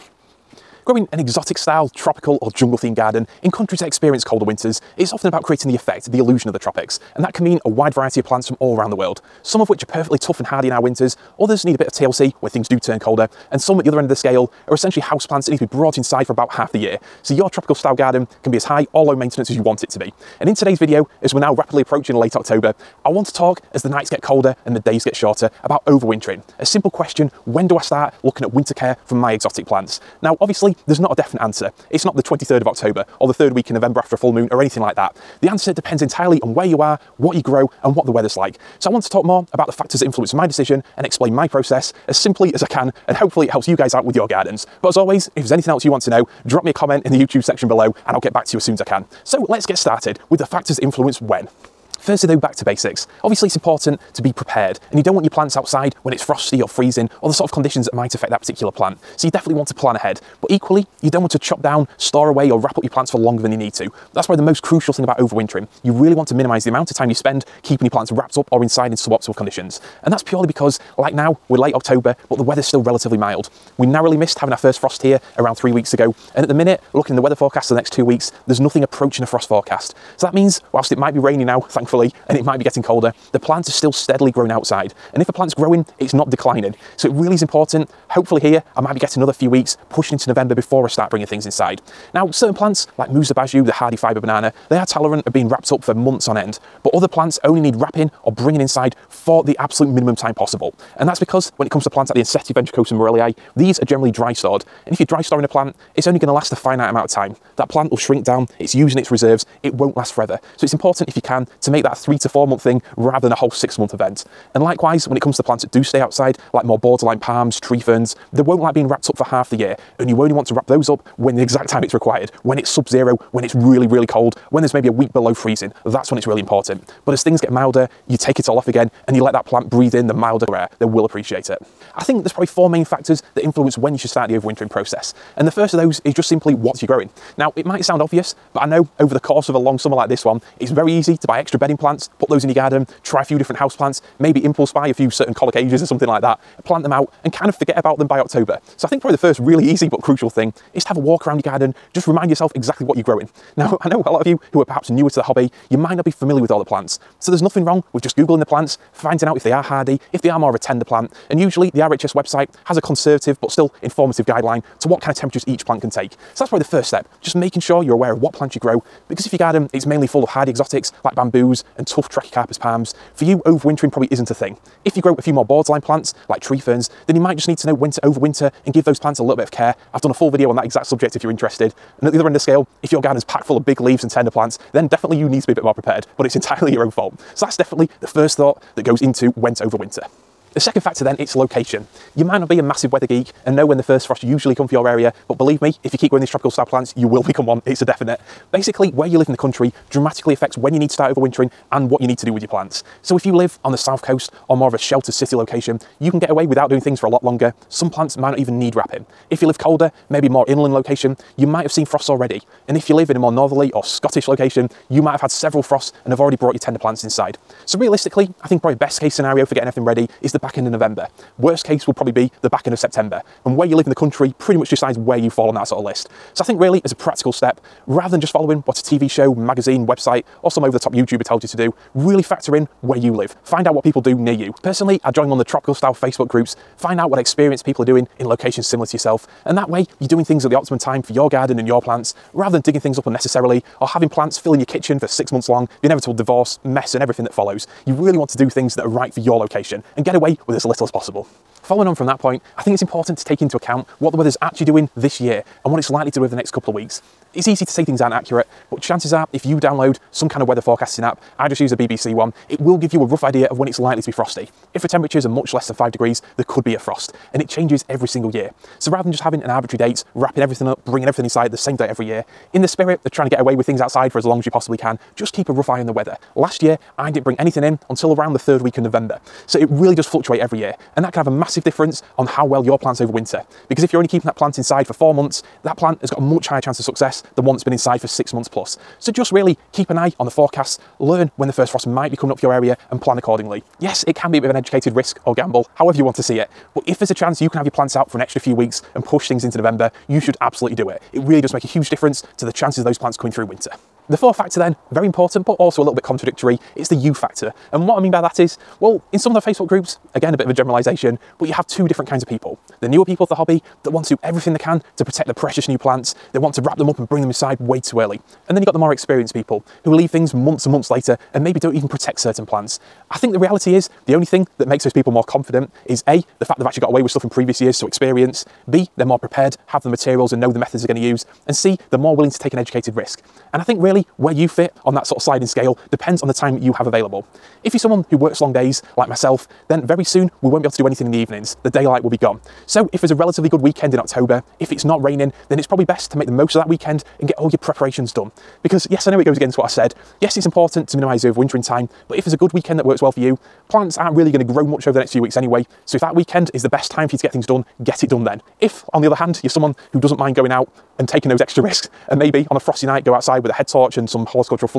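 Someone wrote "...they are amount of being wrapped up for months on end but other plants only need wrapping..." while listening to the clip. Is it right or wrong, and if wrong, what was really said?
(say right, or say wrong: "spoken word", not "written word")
wrong: "tolerant", not "amount".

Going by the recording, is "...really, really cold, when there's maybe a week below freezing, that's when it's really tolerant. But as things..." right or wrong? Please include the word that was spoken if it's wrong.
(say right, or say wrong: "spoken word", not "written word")
wrong: "important", not "tolerant".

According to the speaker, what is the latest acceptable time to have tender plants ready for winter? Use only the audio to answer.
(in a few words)
back end of September.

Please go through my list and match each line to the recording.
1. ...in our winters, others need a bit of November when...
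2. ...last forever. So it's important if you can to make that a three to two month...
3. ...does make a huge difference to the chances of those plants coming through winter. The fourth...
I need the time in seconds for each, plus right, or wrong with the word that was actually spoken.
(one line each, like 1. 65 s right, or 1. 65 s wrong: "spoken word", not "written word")
1. 10 s wrong: "TLC", not "November"
2. 109 s wrong: "four", not "two"
3. 301 s right.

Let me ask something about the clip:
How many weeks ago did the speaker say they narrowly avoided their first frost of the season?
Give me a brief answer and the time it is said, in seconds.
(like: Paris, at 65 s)
3 weeks, at 75 s.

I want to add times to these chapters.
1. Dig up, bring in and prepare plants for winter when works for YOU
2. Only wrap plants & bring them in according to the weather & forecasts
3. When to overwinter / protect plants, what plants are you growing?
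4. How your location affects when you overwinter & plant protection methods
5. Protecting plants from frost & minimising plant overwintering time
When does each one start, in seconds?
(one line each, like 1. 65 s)
1. 303 s
2. 251 s
3. 131 s
4. 190 s
5. 51 s.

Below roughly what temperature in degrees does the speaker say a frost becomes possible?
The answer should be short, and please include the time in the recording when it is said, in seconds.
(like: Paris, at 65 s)
5 degrees, at 265 s.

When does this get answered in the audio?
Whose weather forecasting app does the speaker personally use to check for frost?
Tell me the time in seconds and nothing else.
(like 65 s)
261 s.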